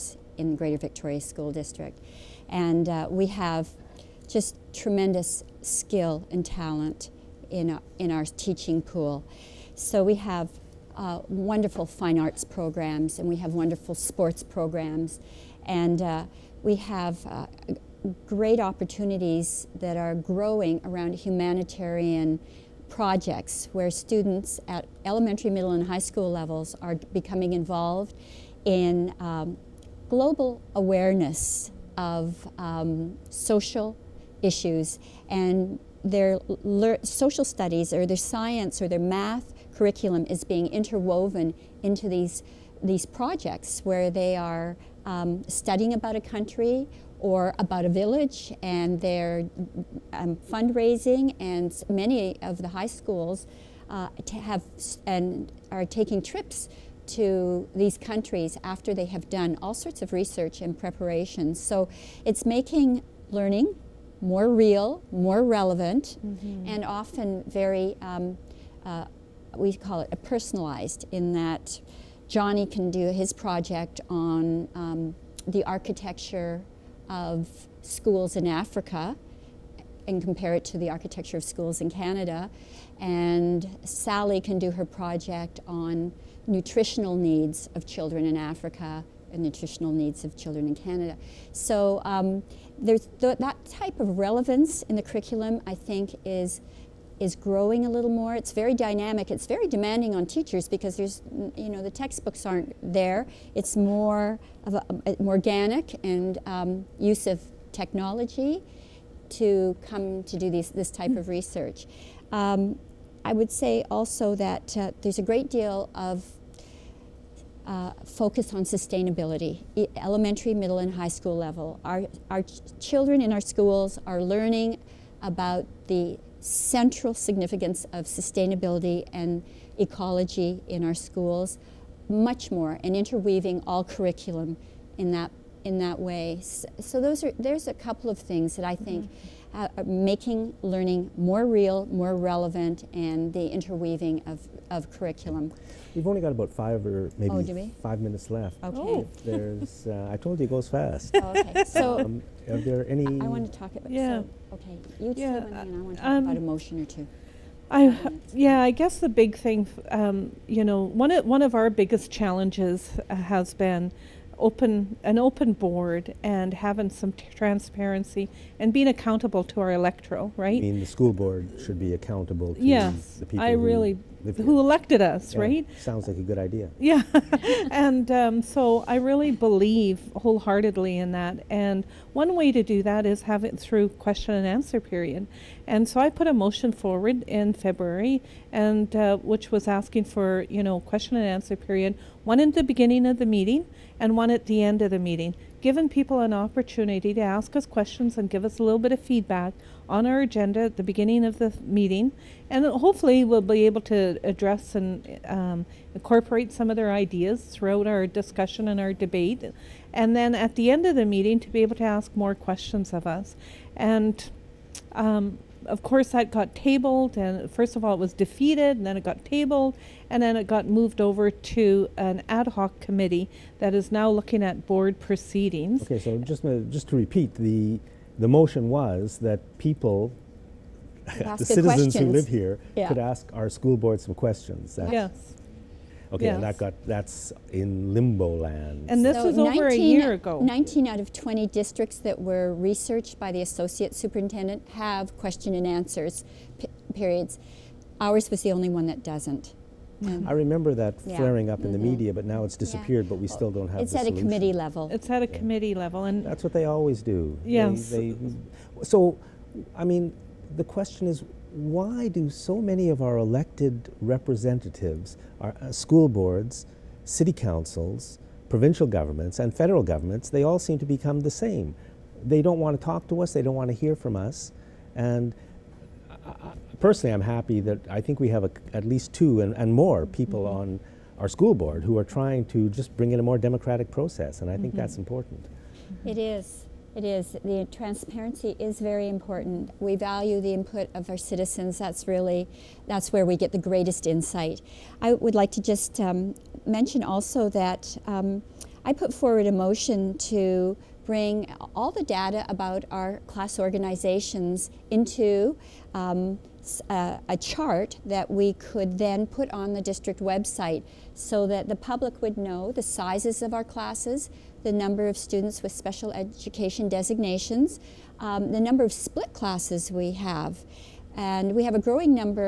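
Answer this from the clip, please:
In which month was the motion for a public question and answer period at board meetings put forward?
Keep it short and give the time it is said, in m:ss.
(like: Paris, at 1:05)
February, at 3:07.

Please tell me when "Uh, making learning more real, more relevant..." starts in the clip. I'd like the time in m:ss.
2:19.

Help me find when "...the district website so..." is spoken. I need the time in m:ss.
5:09.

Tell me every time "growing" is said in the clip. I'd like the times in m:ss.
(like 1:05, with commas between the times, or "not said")
0:20, 1:37, 5:21.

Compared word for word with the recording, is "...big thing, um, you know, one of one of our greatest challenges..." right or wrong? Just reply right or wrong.
wrong.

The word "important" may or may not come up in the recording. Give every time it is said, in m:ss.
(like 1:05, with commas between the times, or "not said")
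4:44, 4:49.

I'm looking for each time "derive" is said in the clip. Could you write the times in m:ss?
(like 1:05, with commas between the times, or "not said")
not said.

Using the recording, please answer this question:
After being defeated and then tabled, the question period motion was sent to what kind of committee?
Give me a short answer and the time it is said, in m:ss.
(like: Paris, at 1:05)
Ad hoc committee, at 3:42.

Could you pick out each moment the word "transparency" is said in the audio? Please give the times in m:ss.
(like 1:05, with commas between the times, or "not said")
2:47, 4:47.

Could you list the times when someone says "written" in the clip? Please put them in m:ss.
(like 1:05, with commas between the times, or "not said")
not said.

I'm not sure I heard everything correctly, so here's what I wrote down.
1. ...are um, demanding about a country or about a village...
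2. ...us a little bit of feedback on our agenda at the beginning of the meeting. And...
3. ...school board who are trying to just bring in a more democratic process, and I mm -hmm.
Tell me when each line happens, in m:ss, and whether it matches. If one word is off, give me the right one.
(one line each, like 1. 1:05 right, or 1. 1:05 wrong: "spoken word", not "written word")
1. 0:44 wrong: "studying", not "demanding"
2. 3:18 right
3. 4:41 right.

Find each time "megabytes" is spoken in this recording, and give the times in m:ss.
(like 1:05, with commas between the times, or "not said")
not said.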